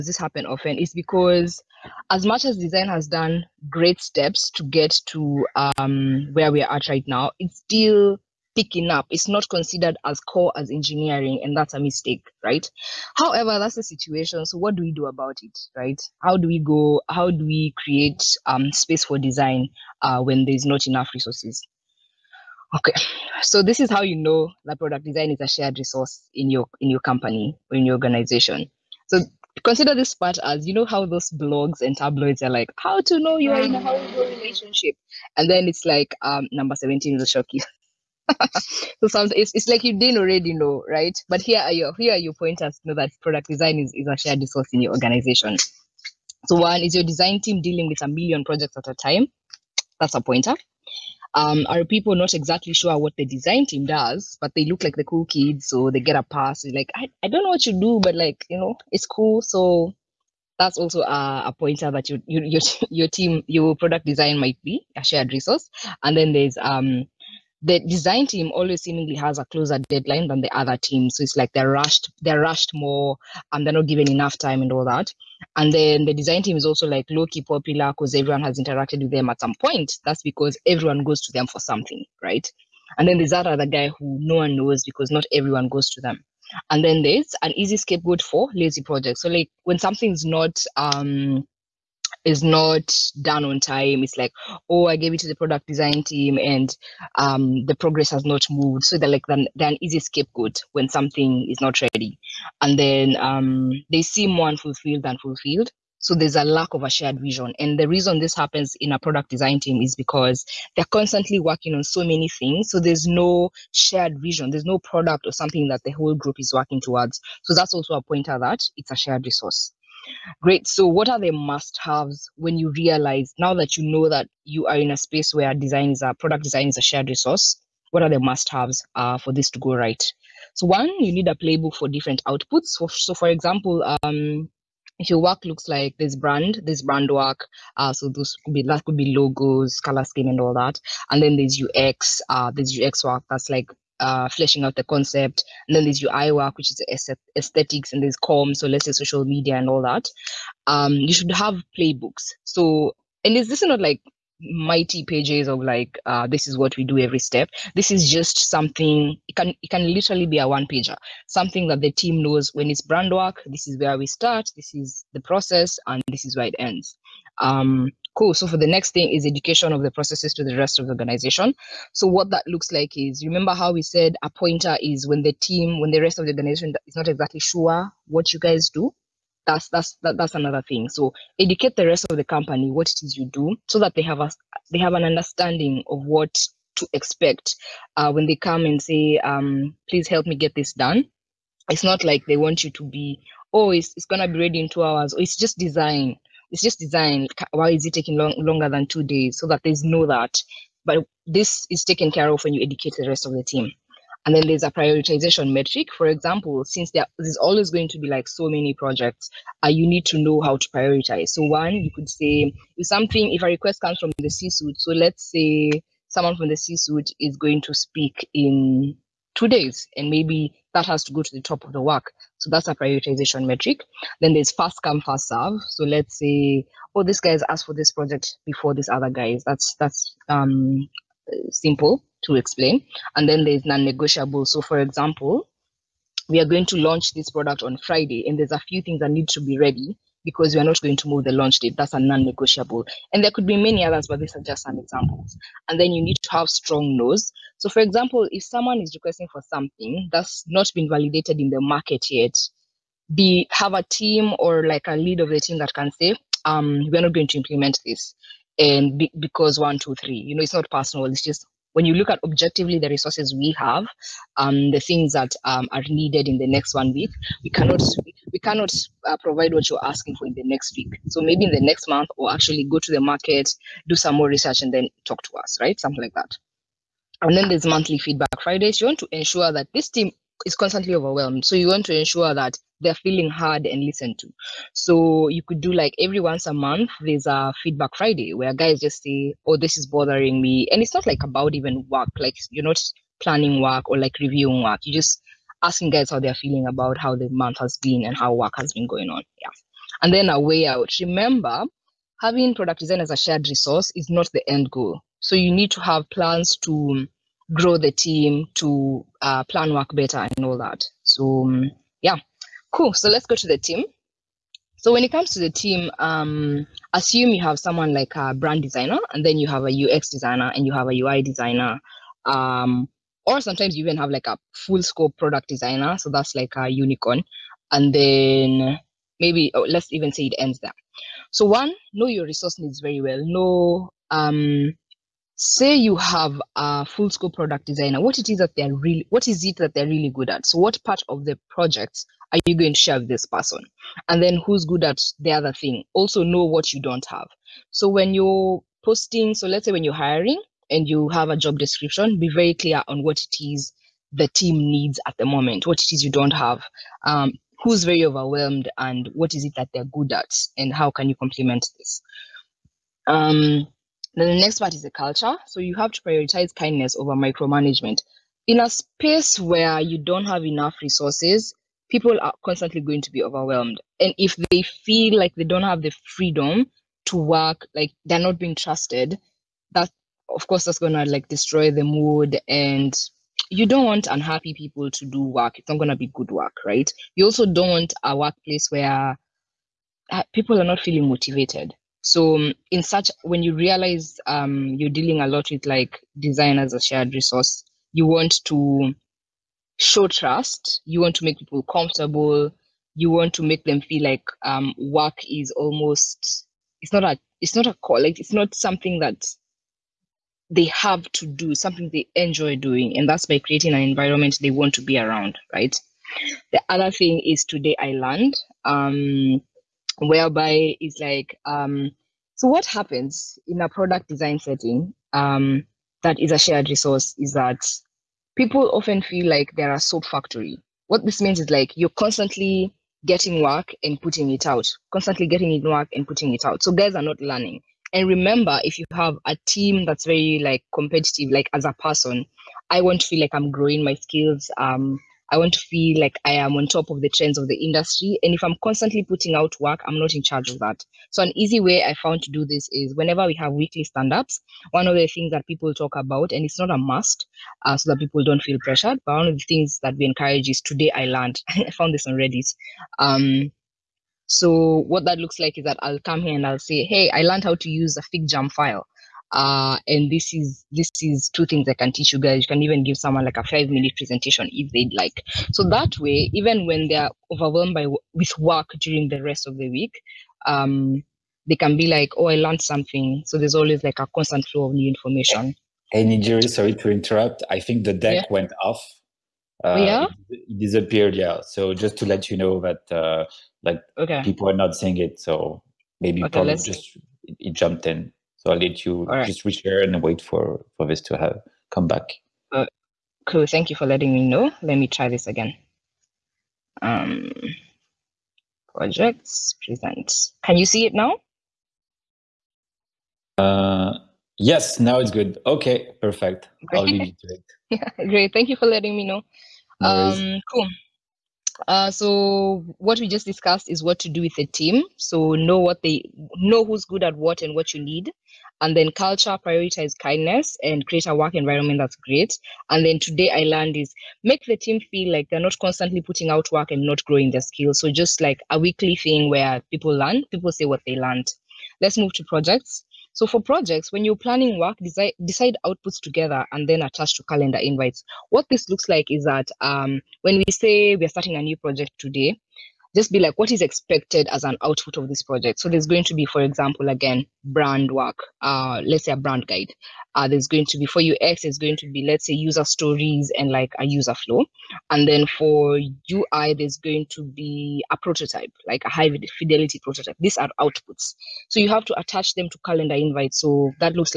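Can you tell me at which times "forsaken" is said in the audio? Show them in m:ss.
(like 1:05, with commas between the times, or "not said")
not said.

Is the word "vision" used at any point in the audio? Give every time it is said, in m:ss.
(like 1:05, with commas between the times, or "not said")
1:47, 1:54.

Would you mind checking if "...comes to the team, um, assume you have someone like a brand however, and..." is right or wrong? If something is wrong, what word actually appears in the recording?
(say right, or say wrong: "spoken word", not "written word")
wrong: "designer", not "however".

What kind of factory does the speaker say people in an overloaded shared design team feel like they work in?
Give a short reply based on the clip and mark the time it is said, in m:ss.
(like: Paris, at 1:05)
soap factory, at 7:09.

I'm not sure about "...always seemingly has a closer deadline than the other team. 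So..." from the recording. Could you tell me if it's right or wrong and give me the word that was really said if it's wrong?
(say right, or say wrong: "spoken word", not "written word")
right.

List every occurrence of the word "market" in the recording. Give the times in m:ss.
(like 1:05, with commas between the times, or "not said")
4:11, 4:33.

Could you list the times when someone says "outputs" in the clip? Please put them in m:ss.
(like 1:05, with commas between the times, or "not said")
2:12, 9:05, 9:14, 9:30.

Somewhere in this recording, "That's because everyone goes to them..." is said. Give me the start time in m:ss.
1:20.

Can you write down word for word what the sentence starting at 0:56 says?
like, I, I don't know what you do, but like, you know, it's cool.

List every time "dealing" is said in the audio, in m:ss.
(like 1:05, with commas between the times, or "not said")
0:47, 6:34.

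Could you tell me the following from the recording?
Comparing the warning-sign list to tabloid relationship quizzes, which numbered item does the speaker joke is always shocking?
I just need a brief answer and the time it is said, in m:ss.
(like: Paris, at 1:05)
17, at 0:36.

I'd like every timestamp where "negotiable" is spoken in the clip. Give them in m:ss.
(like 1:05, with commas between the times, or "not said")
3:53, 4:02.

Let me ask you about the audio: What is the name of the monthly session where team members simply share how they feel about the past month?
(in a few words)
feedback Friday.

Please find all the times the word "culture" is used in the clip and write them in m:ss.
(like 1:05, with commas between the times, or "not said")
6:04, 8:48.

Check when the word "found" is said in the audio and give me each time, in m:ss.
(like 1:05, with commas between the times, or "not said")
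7:32, 7:41.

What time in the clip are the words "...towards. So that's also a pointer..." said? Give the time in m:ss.
1:56.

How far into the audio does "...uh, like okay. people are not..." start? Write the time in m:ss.
8:12.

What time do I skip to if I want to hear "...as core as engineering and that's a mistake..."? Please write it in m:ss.
0:10.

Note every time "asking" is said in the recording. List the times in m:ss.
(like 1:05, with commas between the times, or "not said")
4:29, 4:55.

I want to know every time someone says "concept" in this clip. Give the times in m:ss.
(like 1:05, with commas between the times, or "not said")
2:24.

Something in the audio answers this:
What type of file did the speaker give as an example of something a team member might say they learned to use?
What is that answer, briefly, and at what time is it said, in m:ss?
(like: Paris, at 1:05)
FigJam file, at 7:48.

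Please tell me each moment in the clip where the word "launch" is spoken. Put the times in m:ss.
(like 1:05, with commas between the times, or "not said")
3:56, 4:01.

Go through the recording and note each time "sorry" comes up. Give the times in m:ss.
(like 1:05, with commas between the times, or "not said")
8:06.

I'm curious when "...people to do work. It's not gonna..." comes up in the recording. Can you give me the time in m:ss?
6:24.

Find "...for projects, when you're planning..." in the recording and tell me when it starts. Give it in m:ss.
9:03.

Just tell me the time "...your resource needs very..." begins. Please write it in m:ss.
5:32.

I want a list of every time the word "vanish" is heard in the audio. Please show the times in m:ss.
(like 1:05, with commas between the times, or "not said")
not said.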